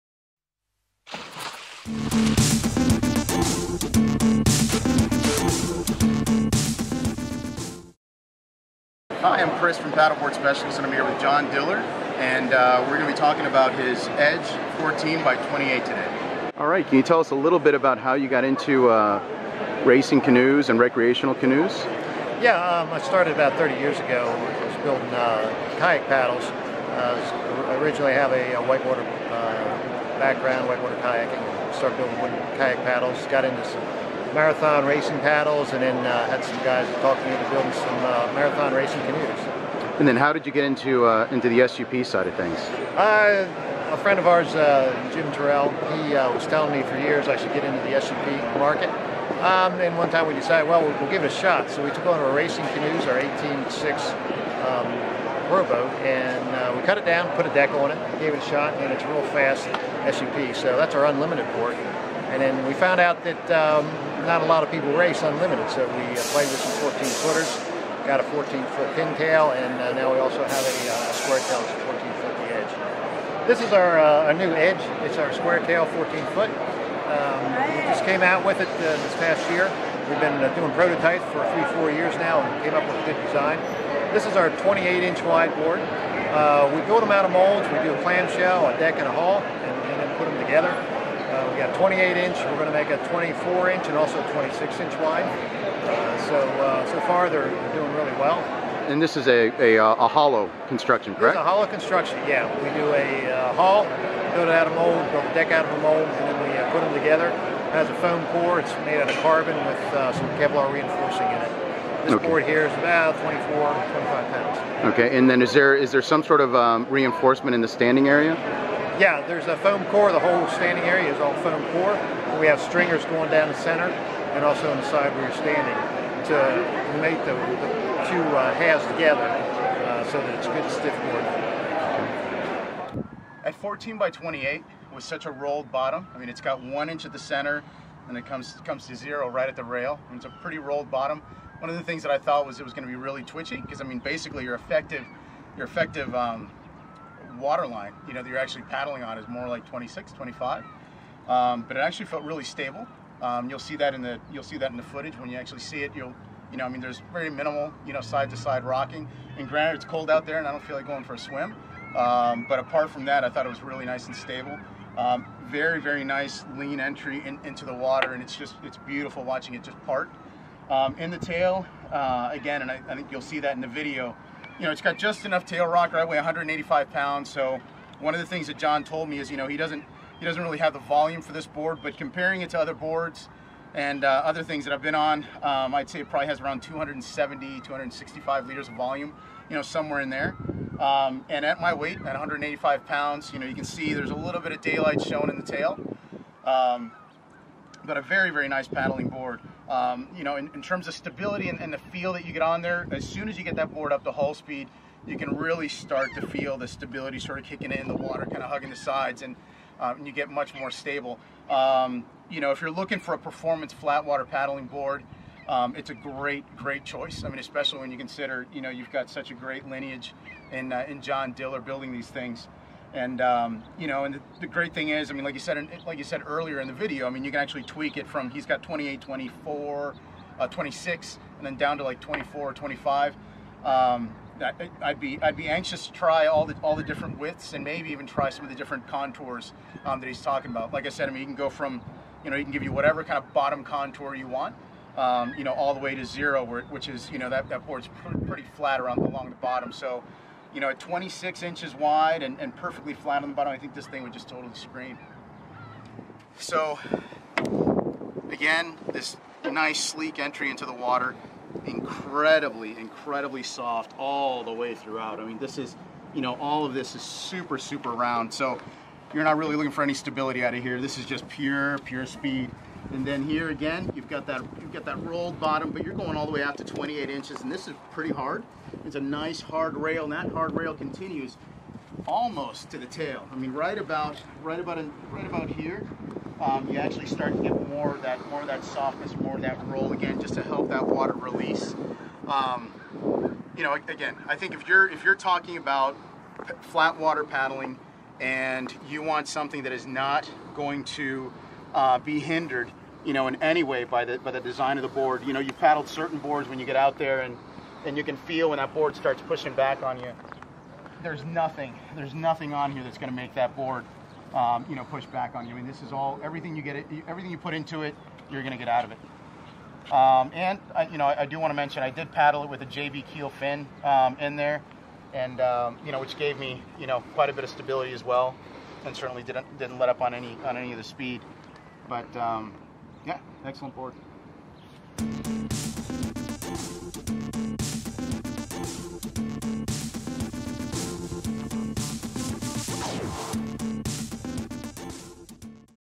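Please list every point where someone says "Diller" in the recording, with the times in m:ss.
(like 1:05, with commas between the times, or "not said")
0:11, 3:41.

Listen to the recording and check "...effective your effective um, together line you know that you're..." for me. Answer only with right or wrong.
wrong.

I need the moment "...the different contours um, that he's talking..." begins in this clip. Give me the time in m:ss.
3:58.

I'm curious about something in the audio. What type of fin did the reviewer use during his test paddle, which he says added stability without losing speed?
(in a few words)
JB keel fin.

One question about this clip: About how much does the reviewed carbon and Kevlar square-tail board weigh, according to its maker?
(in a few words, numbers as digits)
24-25 pounds.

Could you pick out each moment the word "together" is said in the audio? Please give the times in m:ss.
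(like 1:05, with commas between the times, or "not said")
1:30, 1:46, 2:08.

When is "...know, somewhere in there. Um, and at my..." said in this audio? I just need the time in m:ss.
3:09.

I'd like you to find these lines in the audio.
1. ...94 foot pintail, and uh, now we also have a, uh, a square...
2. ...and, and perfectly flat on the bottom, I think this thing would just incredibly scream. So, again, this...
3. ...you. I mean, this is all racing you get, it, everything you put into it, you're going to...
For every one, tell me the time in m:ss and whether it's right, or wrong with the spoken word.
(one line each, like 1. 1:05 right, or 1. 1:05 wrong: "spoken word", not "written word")
1. 1:08 wrong: "14", not "94"
2. 4:12 wrong: "totally", not "incredibly"
3. 5:15 wrong: "everything", not "racing".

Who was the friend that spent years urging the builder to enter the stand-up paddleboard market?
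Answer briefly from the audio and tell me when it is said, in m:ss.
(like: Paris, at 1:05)
Jim Terrell, at 0:45.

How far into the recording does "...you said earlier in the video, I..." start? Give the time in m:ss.
3:45.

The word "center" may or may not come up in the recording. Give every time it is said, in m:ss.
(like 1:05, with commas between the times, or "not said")
2:03, 2:17.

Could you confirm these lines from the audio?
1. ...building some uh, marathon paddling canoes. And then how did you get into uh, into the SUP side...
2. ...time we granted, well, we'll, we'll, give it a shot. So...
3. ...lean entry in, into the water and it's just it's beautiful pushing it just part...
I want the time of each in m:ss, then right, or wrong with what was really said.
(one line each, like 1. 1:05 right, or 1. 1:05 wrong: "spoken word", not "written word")
1. 0:37 wrong: "racing", not "paddling"
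2. 0:50 wrong: "decided", not "granted"
3. 2:46 wrong: "watching", not "pushing".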